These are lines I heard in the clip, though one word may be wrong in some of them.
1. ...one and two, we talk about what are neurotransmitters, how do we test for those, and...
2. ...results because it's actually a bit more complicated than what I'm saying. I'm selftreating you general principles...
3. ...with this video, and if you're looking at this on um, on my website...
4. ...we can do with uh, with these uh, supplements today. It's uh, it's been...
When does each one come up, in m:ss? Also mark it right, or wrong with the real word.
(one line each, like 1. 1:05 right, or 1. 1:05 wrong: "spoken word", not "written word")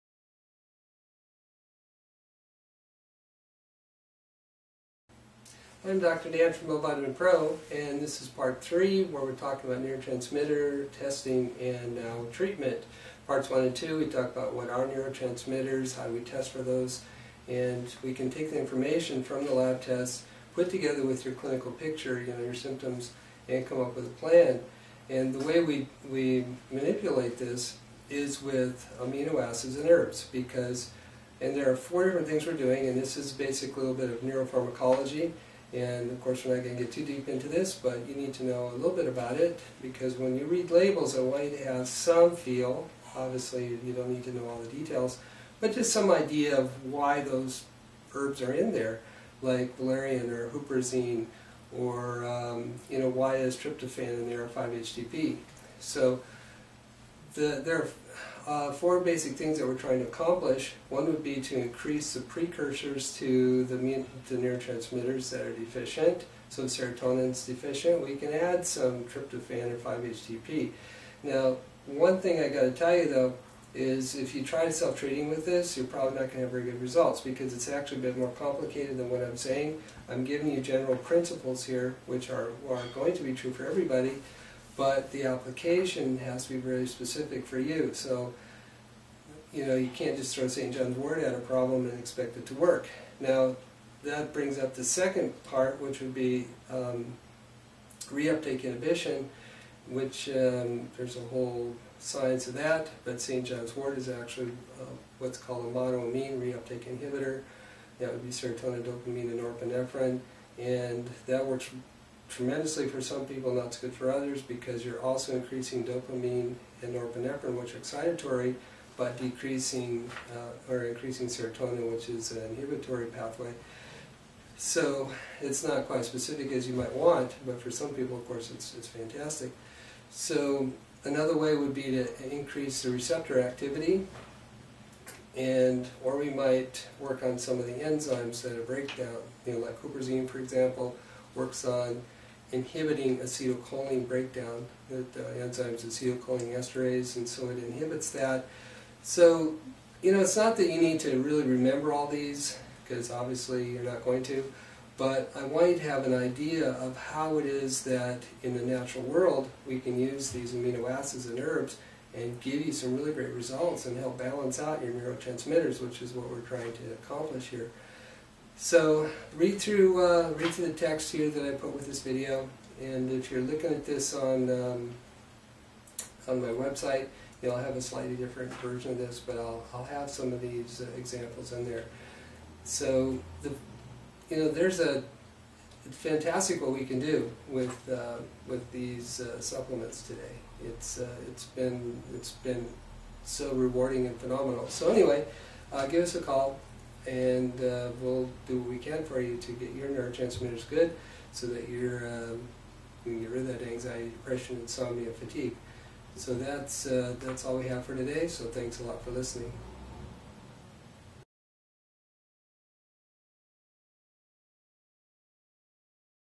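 1. 0:13 right
2. 1:16 wrong: "giving", not "selftreating"
3. 2:51 right
4. 3:06 right.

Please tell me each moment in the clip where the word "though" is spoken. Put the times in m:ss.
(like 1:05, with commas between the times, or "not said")
1:13.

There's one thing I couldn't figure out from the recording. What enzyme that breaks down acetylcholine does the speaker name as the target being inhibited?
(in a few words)
Acetylcholine esterase.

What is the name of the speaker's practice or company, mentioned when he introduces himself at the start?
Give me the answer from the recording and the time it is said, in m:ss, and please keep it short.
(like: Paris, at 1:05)
OVitamin Pro, at 0:06.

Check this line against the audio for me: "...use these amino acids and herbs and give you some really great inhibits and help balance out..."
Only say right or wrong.
wrong.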